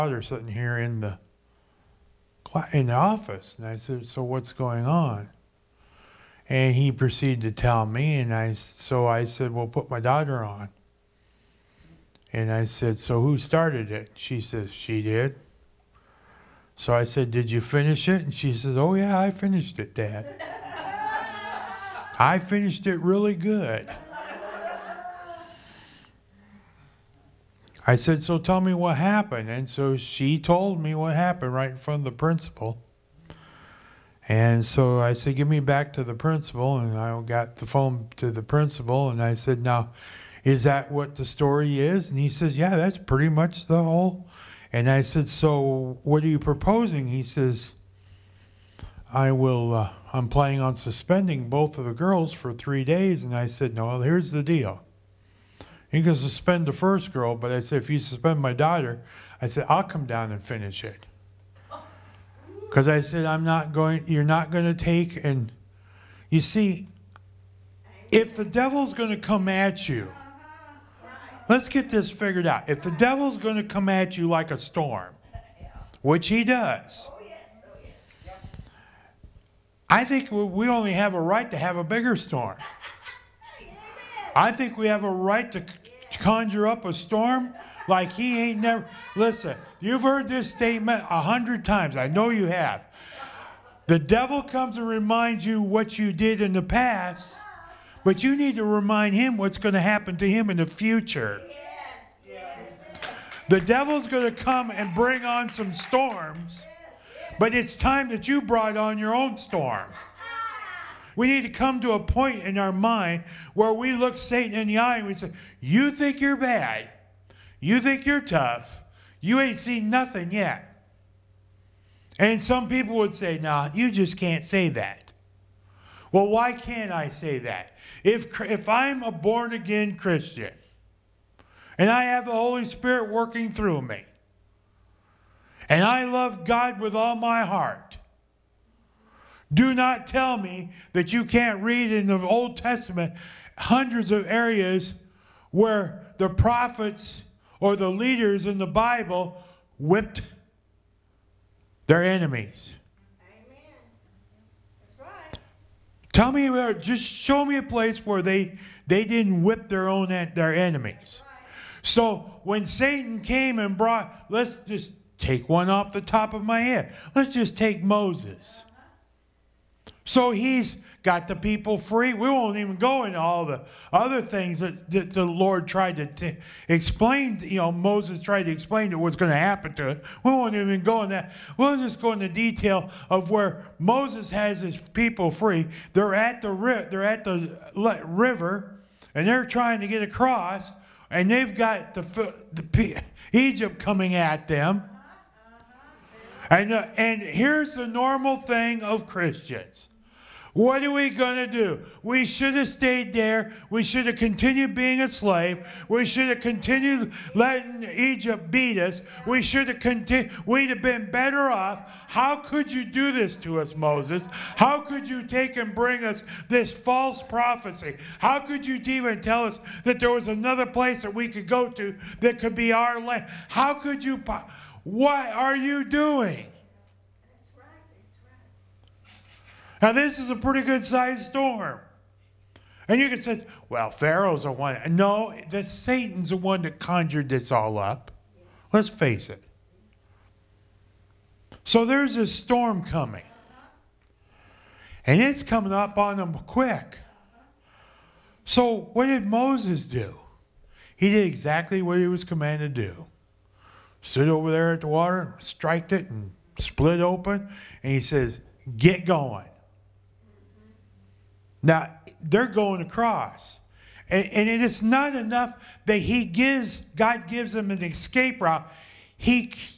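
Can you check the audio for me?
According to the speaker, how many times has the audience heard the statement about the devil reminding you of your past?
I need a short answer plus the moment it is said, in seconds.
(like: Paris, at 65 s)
100, at 91 s.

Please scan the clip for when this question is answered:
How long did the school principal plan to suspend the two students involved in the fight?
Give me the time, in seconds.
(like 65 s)
52 s.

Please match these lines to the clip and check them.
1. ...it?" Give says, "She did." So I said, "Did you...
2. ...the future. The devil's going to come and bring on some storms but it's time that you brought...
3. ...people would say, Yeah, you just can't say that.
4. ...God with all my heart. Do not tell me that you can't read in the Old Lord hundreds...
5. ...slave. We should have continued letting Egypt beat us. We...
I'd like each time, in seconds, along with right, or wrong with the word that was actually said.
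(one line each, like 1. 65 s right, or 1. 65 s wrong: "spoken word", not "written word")
1. 13 s wrong: "She", not "Give"
2. 100 s right
3. 122 s wrong: "Nah", not "Yeah"
4. 136 s wrong: "Testament", not "Lord"
5. 205 s right.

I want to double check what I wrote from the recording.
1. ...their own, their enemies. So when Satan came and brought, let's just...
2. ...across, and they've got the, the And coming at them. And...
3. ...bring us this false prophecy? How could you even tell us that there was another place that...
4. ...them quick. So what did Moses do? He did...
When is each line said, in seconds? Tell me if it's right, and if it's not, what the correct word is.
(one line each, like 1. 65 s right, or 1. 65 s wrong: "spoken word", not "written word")
1. 159 s right
2. 190 s wrong: "Egypt", not "And"
3. 215 s right
4. 246 s right.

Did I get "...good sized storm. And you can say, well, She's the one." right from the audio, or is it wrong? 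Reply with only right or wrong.
wrong.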